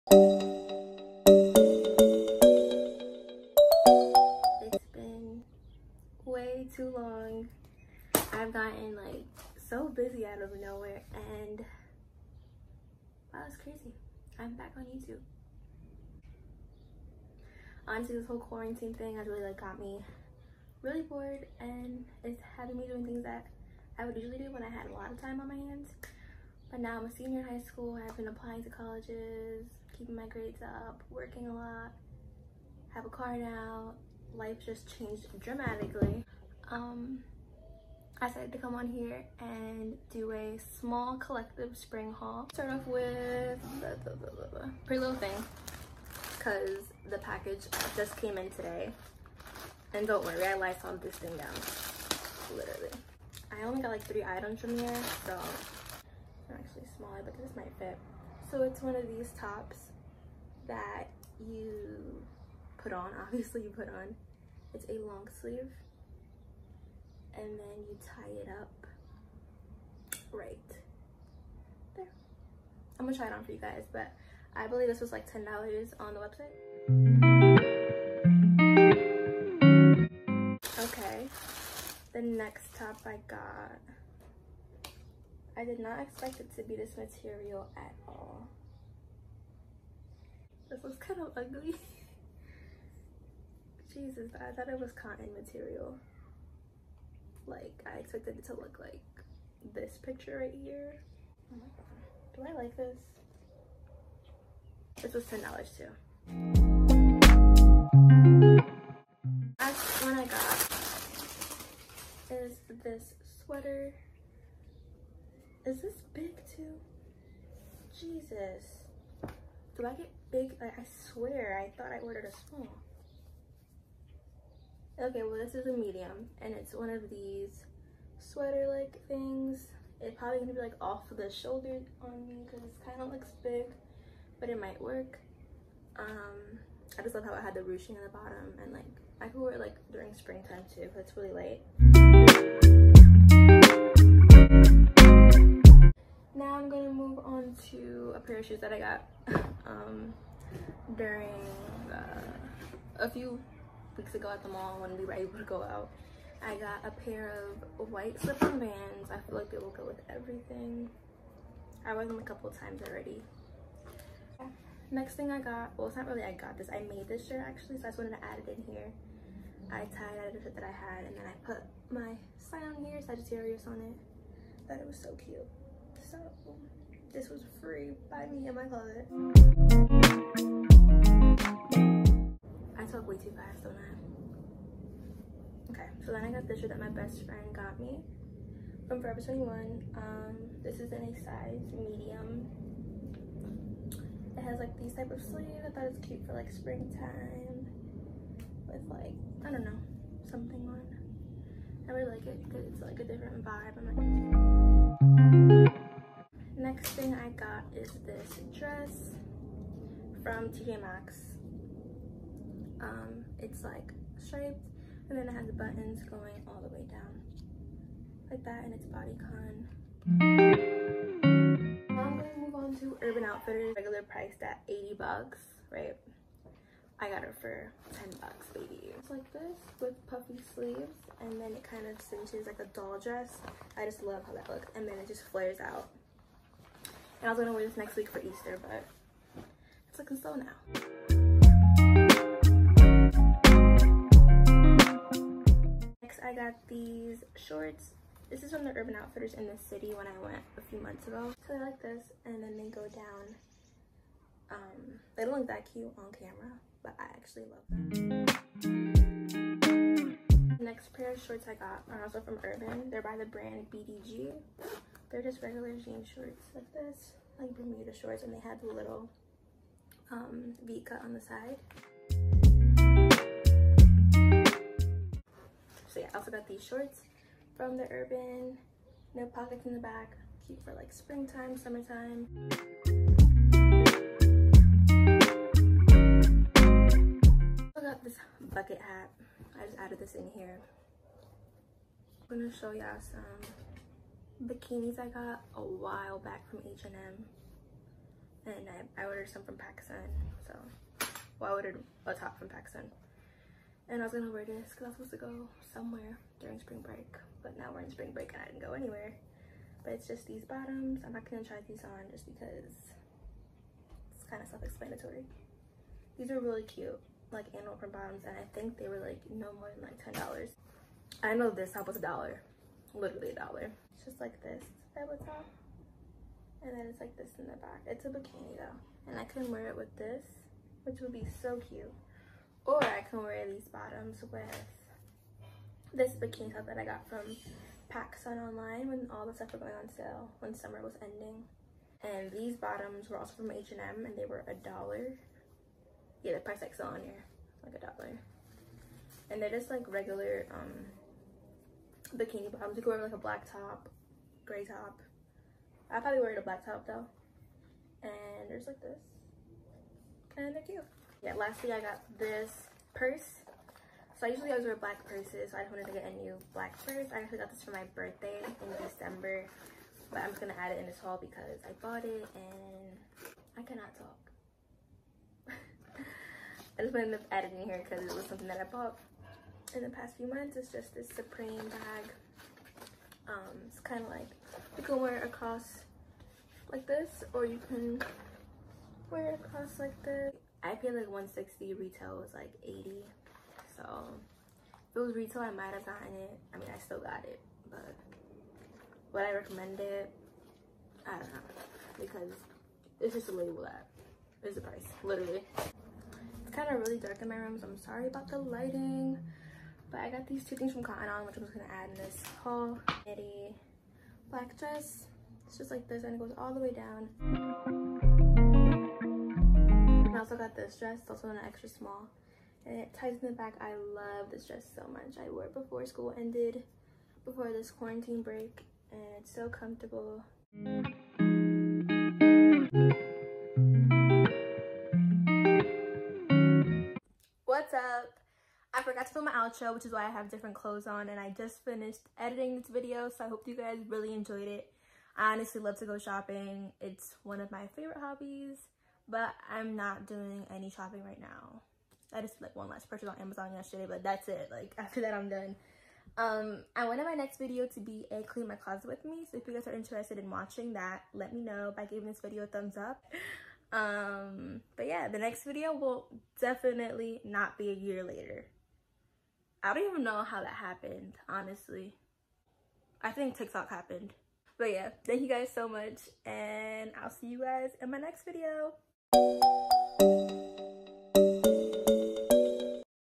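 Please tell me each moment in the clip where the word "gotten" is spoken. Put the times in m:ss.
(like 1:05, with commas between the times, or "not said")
0:08, 6:35.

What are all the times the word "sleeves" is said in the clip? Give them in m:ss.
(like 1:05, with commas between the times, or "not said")
1:05, 3:15, 3:50.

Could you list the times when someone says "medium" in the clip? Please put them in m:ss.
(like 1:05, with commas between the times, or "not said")
2:05, 3:11.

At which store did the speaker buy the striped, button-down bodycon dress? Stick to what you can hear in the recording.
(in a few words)
TJ Maxx.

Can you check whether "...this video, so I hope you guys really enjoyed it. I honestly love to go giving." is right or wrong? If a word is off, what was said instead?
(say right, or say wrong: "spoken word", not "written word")
wrong: "shopping", not "giving".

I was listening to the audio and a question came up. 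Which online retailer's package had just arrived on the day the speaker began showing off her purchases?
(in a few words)
Pretty Little Thing.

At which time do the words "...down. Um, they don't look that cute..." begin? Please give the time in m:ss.
4:12.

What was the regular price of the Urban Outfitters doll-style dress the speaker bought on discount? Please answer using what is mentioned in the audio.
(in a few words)
$80.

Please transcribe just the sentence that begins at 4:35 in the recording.
So yeah, I also got these shorts from the Urban.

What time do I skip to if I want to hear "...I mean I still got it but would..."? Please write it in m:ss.
6:36.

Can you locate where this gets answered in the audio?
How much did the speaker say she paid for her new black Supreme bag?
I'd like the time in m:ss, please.
6:31.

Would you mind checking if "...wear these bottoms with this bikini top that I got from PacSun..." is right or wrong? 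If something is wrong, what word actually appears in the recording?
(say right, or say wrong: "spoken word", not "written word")
right.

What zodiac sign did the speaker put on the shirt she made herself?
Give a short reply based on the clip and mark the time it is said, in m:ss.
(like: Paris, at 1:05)
Sagittarius, at 2:53.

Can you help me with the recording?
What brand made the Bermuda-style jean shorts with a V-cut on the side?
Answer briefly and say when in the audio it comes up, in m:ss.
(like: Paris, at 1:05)
BDG, at 4:23.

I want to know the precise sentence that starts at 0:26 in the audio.
But now I'm a senior in high school.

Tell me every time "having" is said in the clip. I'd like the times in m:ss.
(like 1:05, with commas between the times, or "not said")
0:22.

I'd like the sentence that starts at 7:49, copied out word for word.
I don't even know how that happened, honestly.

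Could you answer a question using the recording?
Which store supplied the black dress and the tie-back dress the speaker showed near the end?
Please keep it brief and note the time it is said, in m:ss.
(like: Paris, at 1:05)
Cotton On, at 6:50.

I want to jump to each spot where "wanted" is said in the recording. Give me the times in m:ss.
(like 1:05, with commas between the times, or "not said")
2:47, 6:05, 6:16, 7:36.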